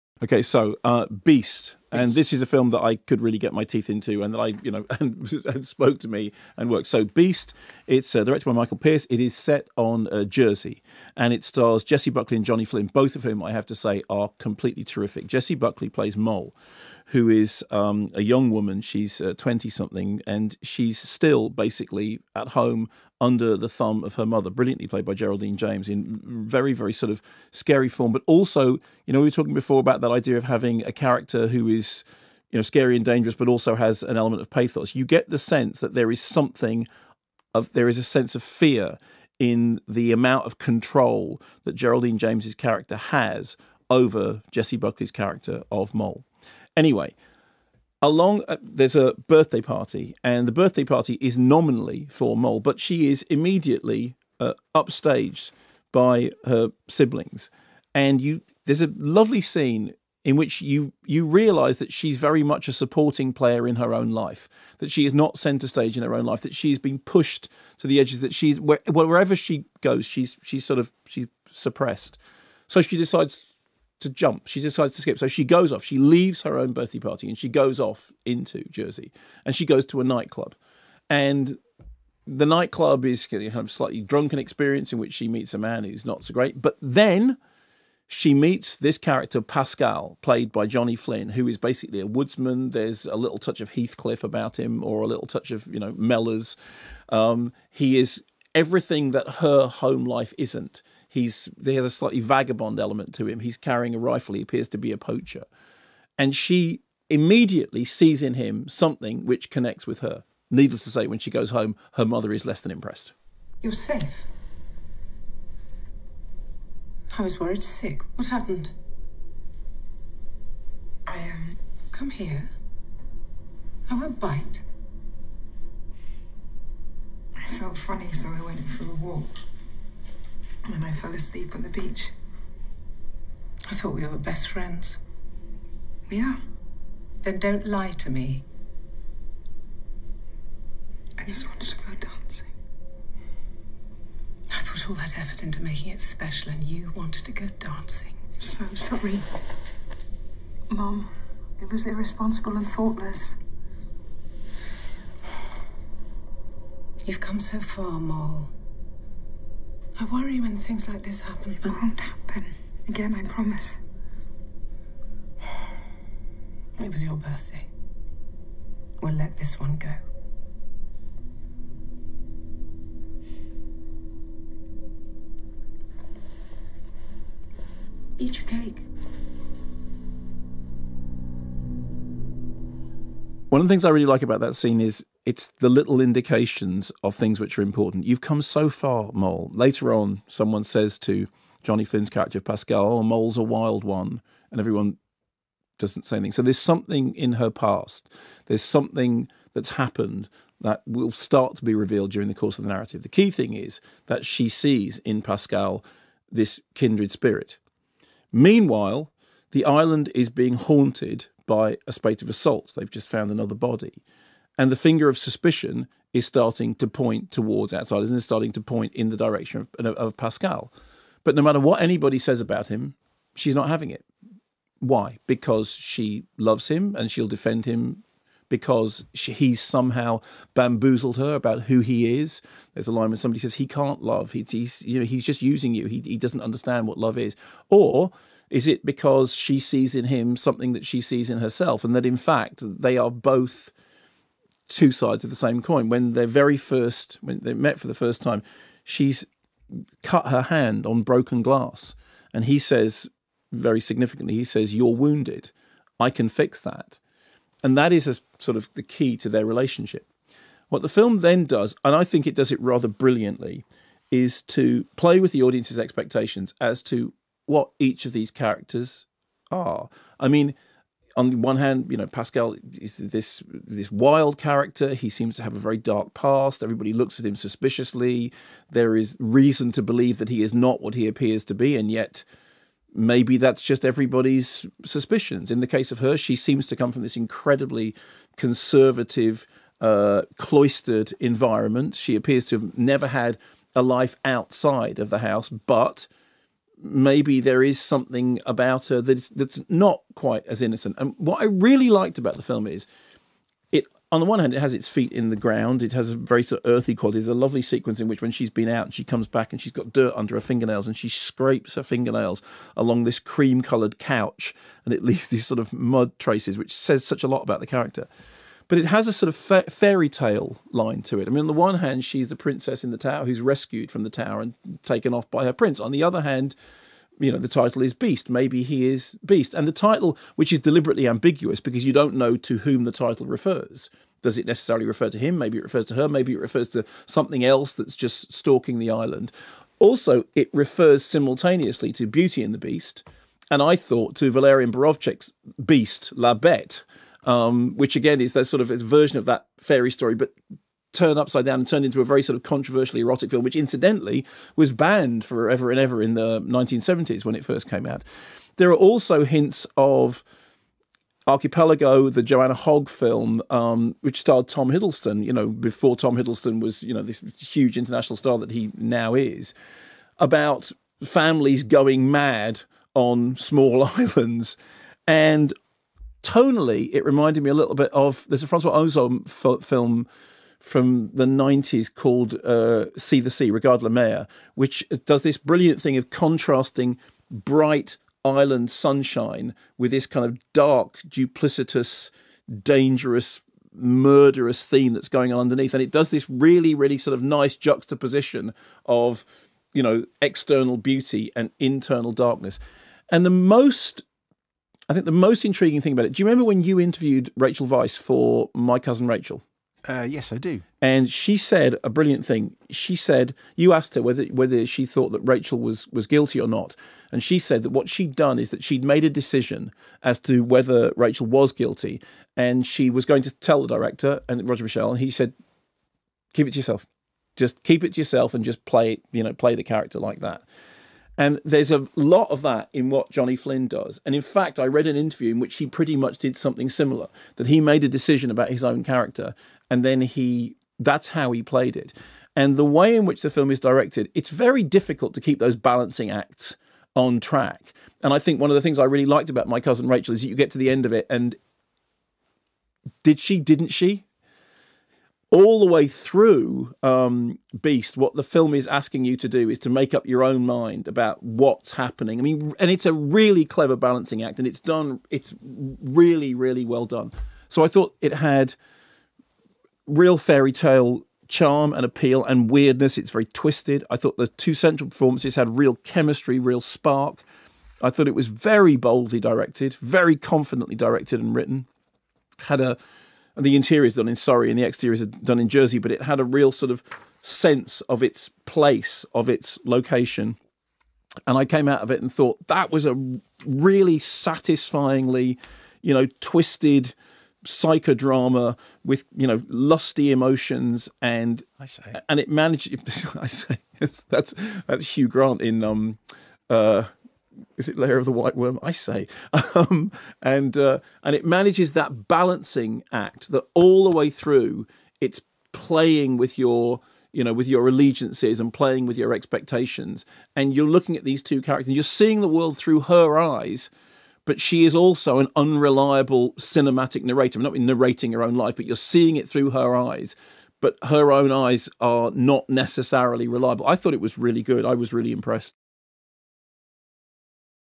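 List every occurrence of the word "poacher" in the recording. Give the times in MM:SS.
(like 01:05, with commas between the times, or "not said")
01:44.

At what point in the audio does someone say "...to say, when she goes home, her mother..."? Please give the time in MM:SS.
01:50.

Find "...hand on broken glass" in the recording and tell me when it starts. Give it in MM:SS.
04:10.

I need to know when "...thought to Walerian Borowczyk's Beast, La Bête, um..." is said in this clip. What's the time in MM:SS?
05:43.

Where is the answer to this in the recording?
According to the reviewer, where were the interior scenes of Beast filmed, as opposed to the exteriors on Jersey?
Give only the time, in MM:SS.
08:04.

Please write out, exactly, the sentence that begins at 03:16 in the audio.
So there's something in her past.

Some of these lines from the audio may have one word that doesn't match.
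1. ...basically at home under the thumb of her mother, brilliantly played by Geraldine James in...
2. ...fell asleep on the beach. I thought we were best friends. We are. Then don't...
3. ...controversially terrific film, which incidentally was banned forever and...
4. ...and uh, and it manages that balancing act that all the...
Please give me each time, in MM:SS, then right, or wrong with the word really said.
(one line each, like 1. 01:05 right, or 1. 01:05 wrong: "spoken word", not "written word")
1. 00:21 right
2. 02:10 right
3. 05:52 wrong: "erotic", not "terrific"
4. 08:30 right.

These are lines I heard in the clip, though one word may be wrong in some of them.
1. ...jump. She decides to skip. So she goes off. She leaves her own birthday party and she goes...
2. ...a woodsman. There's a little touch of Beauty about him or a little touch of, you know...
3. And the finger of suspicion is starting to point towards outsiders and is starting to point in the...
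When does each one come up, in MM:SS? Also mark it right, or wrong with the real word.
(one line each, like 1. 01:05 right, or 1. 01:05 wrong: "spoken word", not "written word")
1. 01:14 right
2. 01:31 wrong: "Heathcliff", not "Beauty"
3. 03:34 right.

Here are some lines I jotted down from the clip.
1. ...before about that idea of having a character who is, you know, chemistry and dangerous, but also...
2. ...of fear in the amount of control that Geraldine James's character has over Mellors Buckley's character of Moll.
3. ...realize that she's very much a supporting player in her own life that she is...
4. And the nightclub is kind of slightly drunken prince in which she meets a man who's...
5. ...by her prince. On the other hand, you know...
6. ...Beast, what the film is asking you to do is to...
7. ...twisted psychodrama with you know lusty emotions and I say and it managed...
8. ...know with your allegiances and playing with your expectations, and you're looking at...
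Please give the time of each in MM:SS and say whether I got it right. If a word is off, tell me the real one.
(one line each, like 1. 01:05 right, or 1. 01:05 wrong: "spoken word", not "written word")
1. 00:29 wrong: "scary", not "chemistry"
2. 00:38 wrong: "Jessie", not "Mellors"
3. 01:01 right
4. 01:21 wrong: "experience", not "prince"
5. 05:25 right
6. 07:37 right
7. 08:16 right
8. 08:37 right.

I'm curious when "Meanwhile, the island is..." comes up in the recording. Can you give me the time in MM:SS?
03:28.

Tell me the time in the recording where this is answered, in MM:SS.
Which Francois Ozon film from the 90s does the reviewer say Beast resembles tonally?
06:22.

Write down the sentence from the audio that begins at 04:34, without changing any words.
He seems to have a very dark past.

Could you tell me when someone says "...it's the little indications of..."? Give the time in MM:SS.
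03:05.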